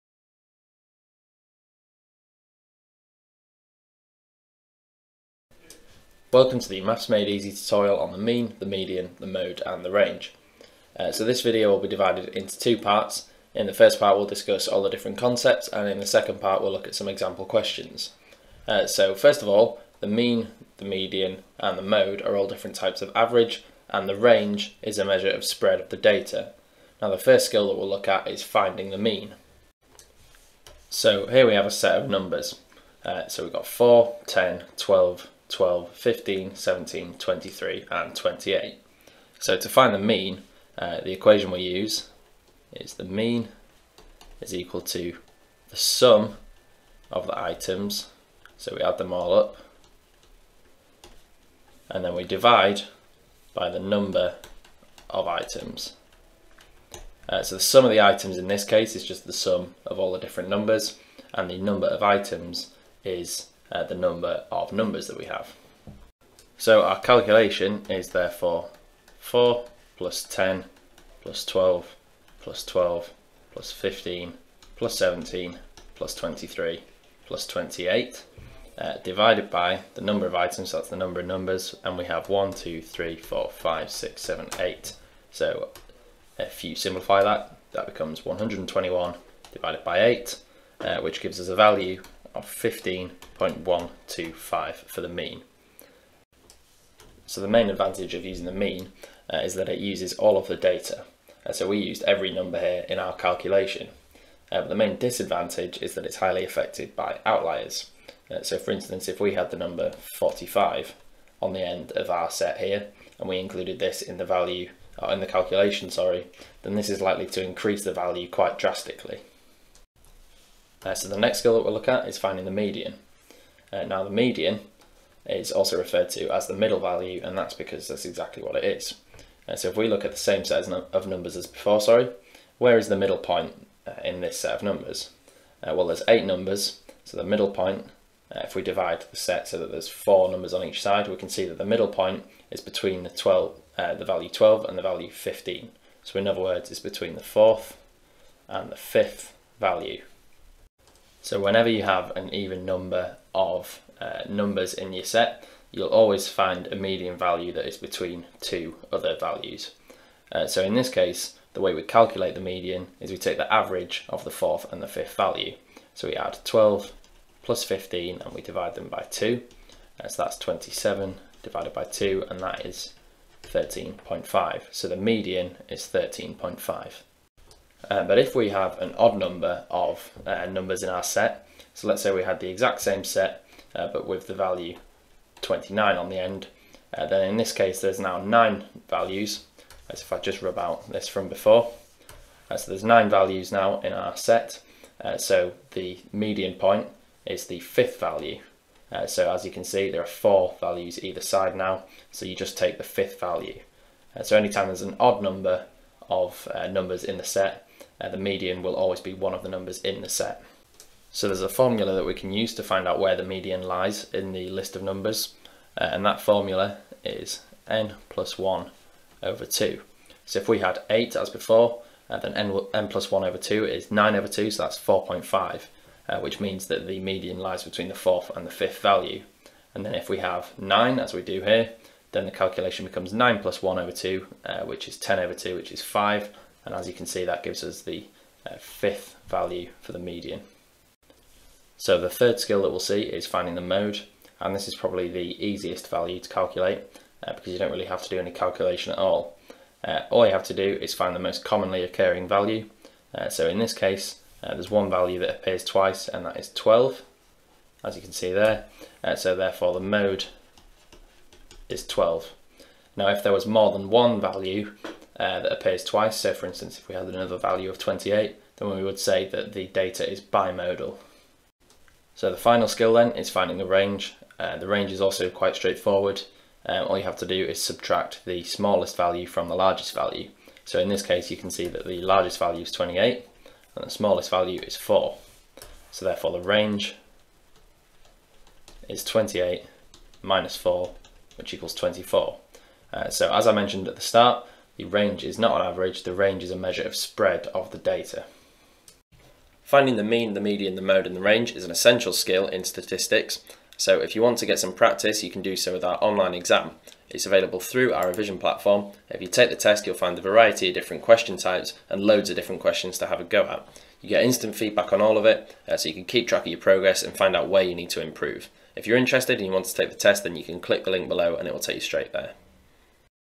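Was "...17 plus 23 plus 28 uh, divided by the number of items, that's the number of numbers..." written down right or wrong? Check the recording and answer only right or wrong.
right.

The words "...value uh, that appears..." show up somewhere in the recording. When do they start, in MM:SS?
04:24.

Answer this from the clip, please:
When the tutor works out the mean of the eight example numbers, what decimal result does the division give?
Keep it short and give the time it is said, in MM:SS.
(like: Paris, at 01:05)
15.125, at 01:32.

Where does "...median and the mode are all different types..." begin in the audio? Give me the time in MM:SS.
00:20.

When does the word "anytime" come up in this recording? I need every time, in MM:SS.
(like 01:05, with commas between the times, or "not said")
03:24.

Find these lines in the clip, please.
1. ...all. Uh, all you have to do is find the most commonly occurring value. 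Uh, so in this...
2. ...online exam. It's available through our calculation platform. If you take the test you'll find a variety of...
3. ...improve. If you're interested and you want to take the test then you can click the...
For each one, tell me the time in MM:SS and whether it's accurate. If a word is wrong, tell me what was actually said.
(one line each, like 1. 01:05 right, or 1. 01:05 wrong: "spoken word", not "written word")
1. 04:08 right
2. 05:06 wrong: "revision", not "calculation"
3. 05:18 right.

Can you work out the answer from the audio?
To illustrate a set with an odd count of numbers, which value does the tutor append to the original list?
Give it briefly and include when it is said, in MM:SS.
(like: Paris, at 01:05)
29, at 03:05.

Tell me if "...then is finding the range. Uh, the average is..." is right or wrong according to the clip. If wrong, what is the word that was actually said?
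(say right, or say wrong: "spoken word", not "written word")
wrong: "range", not "average".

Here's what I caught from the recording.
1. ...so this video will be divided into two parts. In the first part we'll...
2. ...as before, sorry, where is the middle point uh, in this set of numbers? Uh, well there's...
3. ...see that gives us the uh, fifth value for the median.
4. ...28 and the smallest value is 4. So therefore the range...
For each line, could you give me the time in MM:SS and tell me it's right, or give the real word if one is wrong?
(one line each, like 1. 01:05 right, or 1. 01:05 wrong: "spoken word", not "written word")
1. 00:11 right
2. 02:11 right
3. 03:57 right
4. 04:42 right.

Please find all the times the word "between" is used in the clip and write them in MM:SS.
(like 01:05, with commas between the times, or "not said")
02:22, 02:26, 02:37, 03:47.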